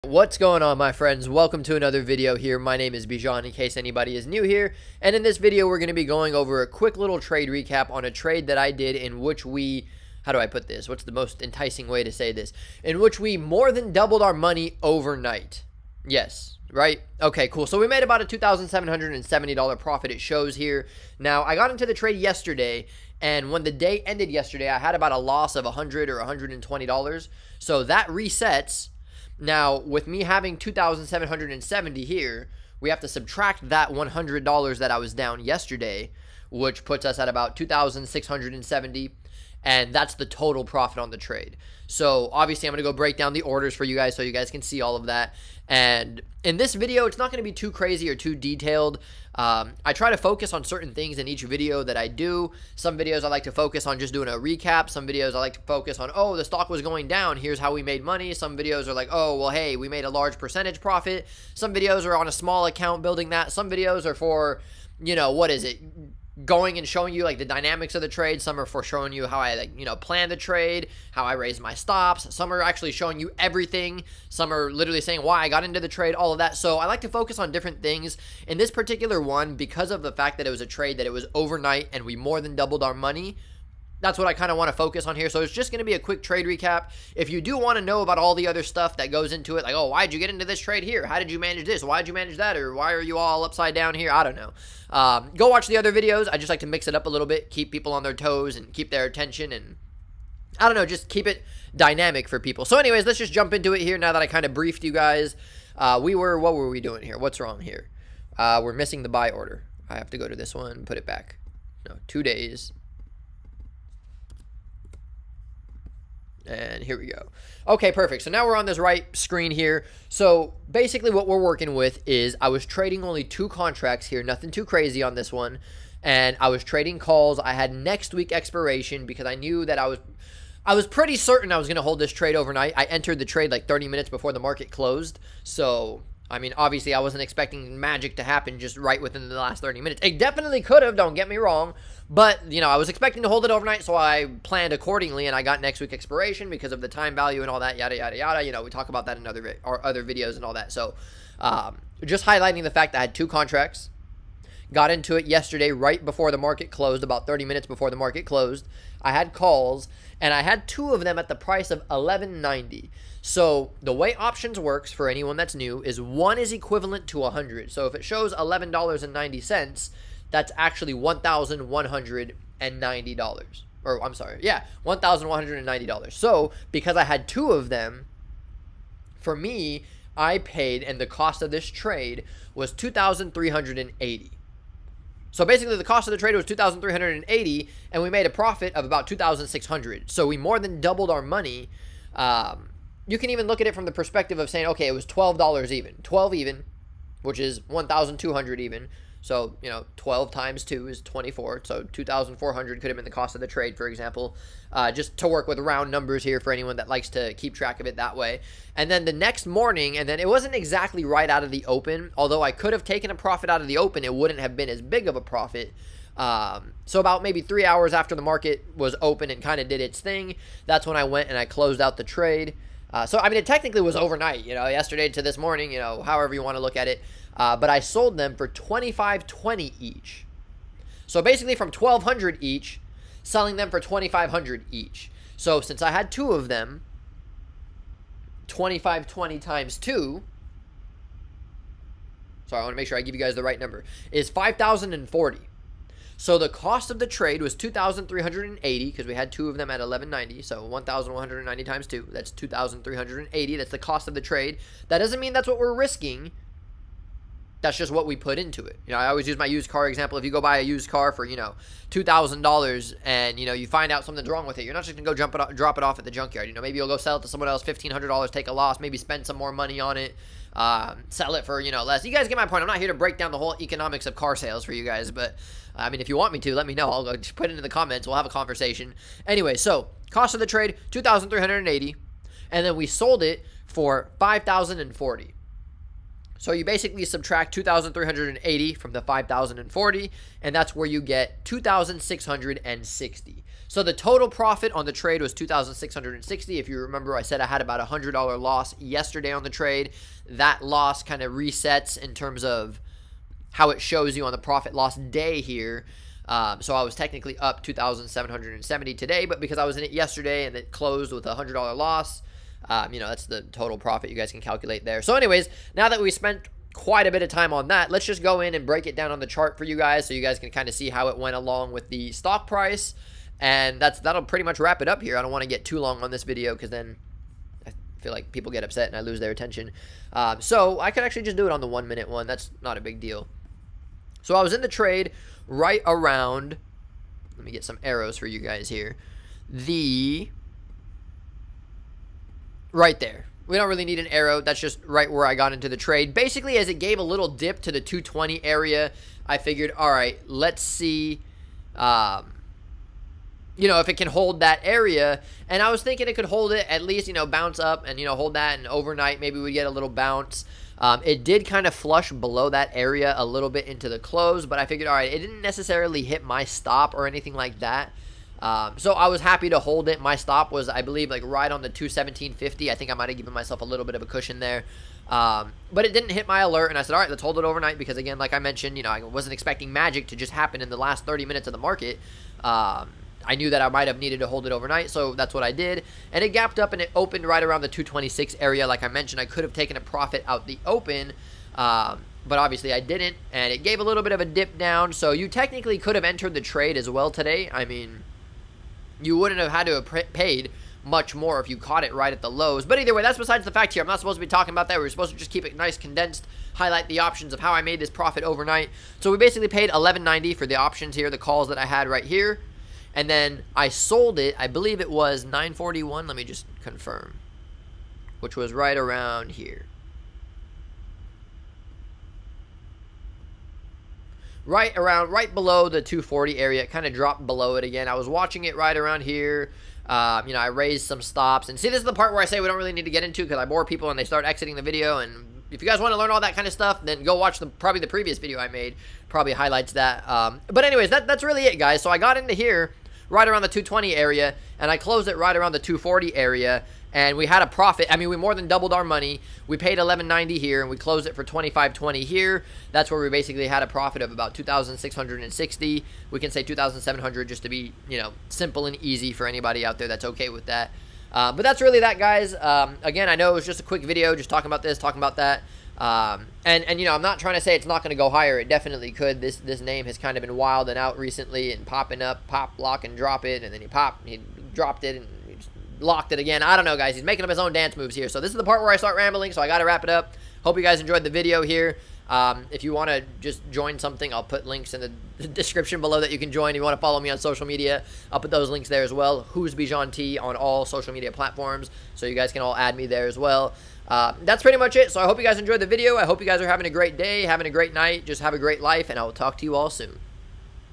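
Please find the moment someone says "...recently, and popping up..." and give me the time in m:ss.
7:50.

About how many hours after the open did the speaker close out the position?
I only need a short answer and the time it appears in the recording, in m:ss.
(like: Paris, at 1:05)
3 hours, at 3:37.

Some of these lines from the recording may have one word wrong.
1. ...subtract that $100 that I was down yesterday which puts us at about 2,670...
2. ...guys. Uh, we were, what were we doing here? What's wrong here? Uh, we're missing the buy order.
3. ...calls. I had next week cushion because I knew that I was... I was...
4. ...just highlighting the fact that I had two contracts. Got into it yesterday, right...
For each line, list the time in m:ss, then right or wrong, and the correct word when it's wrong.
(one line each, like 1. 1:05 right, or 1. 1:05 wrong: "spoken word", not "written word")
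1. 0:33 right
2. 1:44 right
3. 2:06 wrong: "expiration", not "cushion"
4. 2:32 right.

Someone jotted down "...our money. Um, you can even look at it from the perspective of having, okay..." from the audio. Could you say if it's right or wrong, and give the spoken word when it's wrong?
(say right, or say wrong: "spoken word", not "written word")
wrong: "saying", not "having".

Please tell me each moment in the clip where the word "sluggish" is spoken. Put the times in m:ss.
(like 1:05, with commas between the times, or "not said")
not said.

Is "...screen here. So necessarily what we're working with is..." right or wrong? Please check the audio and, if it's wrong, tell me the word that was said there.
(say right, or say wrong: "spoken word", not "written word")
wrong: "basically", not "necessarily".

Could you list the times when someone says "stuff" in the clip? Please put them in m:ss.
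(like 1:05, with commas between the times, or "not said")
1:28, 7:16.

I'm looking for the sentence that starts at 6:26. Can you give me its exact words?
And it gapped up and it opened right around the 226 area.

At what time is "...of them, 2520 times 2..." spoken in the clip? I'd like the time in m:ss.
3:56.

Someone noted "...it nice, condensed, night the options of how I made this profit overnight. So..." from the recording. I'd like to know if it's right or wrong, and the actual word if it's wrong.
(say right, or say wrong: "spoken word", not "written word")
wrong: "highlight", not "night".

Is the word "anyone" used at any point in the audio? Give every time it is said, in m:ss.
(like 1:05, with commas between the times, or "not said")
2:45, 3:26.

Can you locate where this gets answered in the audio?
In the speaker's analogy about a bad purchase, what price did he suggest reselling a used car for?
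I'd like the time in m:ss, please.
4:27.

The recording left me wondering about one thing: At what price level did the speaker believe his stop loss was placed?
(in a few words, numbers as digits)
217.50.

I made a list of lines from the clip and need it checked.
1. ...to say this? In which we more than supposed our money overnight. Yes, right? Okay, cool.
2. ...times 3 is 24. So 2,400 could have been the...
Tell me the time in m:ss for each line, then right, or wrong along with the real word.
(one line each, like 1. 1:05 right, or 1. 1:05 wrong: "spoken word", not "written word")
1. 0:12 wrong: "doubled", not "supposed"
2. 3:20 wrong: "2", not "3".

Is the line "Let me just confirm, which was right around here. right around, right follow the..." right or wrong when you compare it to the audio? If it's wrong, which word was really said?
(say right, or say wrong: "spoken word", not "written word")
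wrong: "below", not "follow".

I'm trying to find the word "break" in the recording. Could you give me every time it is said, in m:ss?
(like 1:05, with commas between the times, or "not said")
0:42, 4:32, 5:18.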